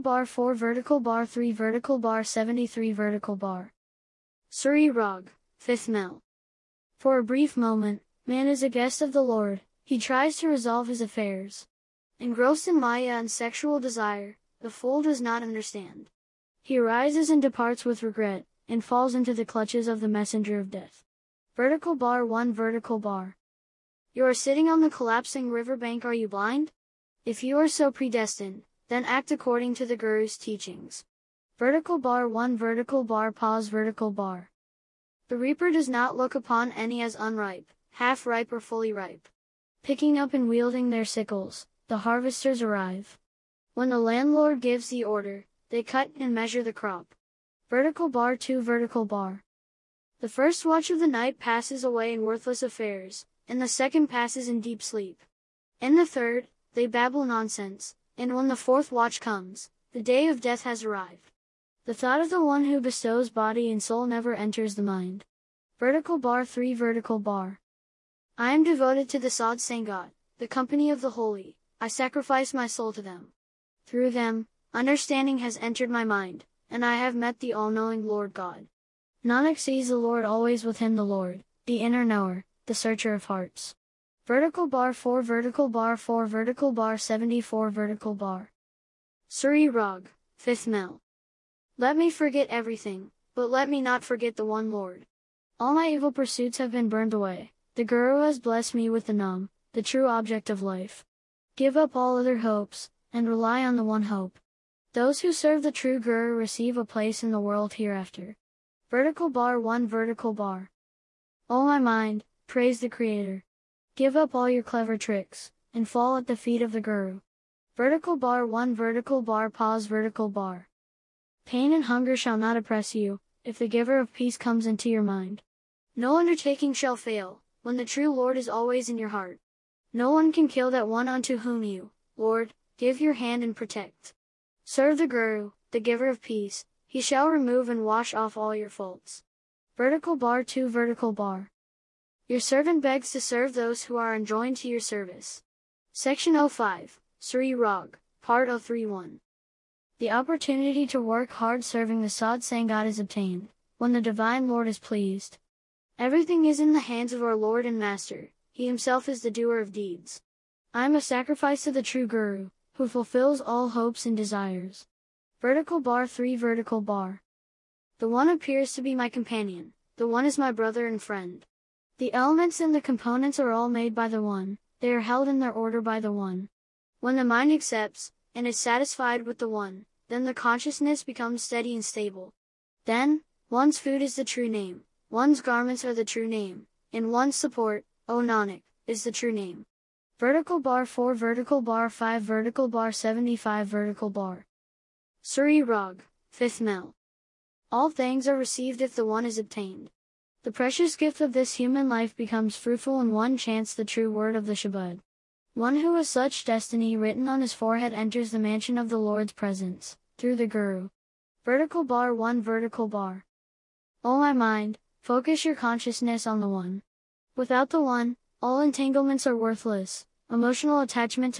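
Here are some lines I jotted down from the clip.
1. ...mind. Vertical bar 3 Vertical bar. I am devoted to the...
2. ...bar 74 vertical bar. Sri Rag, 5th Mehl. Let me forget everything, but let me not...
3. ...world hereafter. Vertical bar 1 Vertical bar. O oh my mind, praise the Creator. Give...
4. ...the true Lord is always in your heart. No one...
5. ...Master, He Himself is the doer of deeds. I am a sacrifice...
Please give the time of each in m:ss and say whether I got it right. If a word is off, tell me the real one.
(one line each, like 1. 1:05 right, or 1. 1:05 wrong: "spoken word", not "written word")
1. 1:04 right
2. 1:26 right
3. 1:47 right
4. 2:07 right
5. 2:37 right.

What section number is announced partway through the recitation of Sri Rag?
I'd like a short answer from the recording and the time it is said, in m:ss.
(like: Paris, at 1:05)
05, at 2:25.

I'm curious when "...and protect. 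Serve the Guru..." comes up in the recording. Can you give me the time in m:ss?
2:13.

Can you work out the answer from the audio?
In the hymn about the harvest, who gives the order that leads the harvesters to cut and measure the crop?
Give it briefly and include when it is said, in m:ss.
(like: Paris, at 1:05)
The landlord, at 0:43.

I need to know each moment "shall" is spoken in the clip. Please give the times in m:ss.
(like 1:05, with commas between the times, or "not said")
2:02, 2:06, 2:17.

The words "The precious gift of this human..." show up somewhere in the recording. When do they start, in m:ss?
3:20.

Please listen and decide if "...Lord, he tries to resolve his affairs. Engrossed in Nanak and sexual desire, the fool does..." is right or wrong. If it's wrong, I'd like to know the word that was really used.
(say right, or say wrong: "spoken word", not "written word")
wrong: "Maya", not "Nanak".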